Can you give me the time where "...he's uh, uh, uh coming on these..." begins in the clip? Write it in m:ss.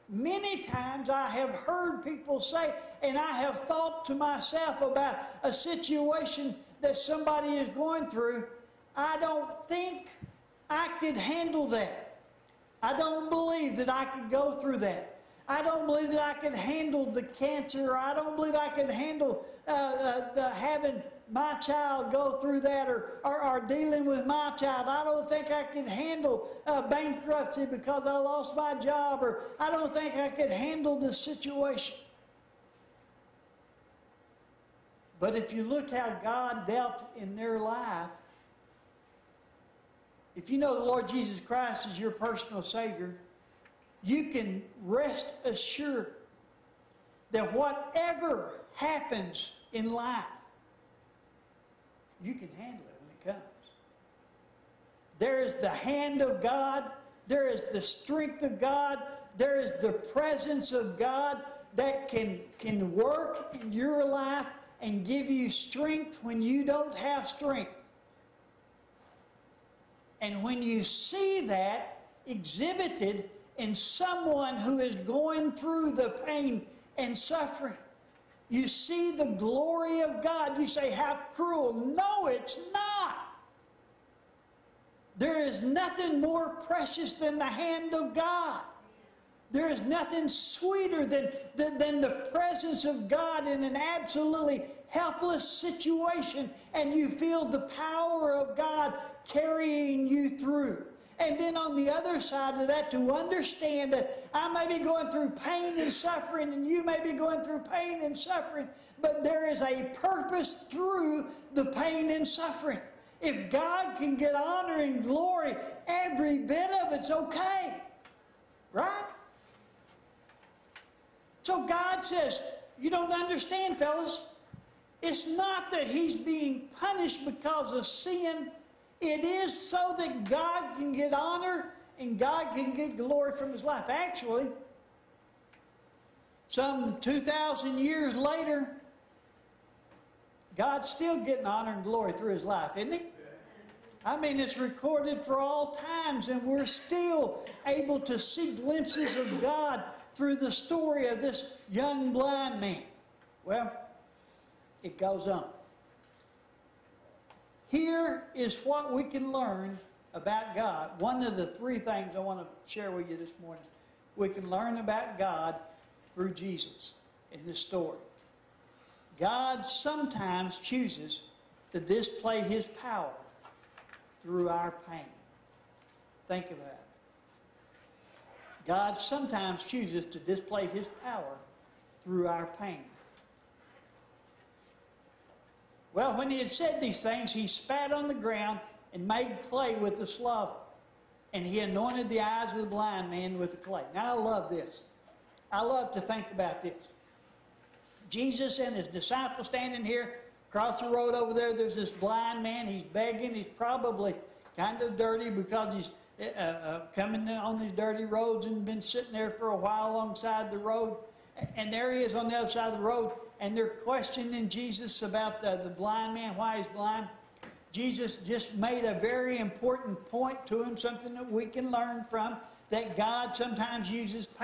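3:25.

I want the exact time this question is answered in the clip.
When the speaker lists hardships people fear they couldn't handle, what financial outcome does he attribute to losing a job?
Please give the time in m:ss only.
0:26.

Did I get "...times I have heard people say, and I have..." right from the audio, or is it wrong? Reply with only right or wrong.
right.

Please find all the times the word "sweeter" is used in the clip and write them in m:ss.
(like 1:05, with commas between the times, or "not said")
1:30.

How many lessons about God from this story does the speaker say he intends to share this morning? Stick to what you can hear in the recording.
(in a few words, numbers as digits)
3.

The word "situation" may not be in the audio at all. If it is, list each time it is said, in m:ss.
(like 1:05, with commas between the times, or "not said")
0:05, 0:31, 1:35.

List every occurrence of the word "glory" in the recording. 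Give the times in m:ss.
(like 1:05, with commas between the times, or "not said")
1:19, 1:55, 2:12, 2:21.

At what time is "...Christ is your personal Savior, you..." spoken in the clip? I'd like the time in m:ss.
0:41.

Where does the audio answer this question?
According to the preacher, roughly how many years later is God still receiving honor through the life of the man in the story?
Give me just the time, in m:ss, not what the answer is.
2:17.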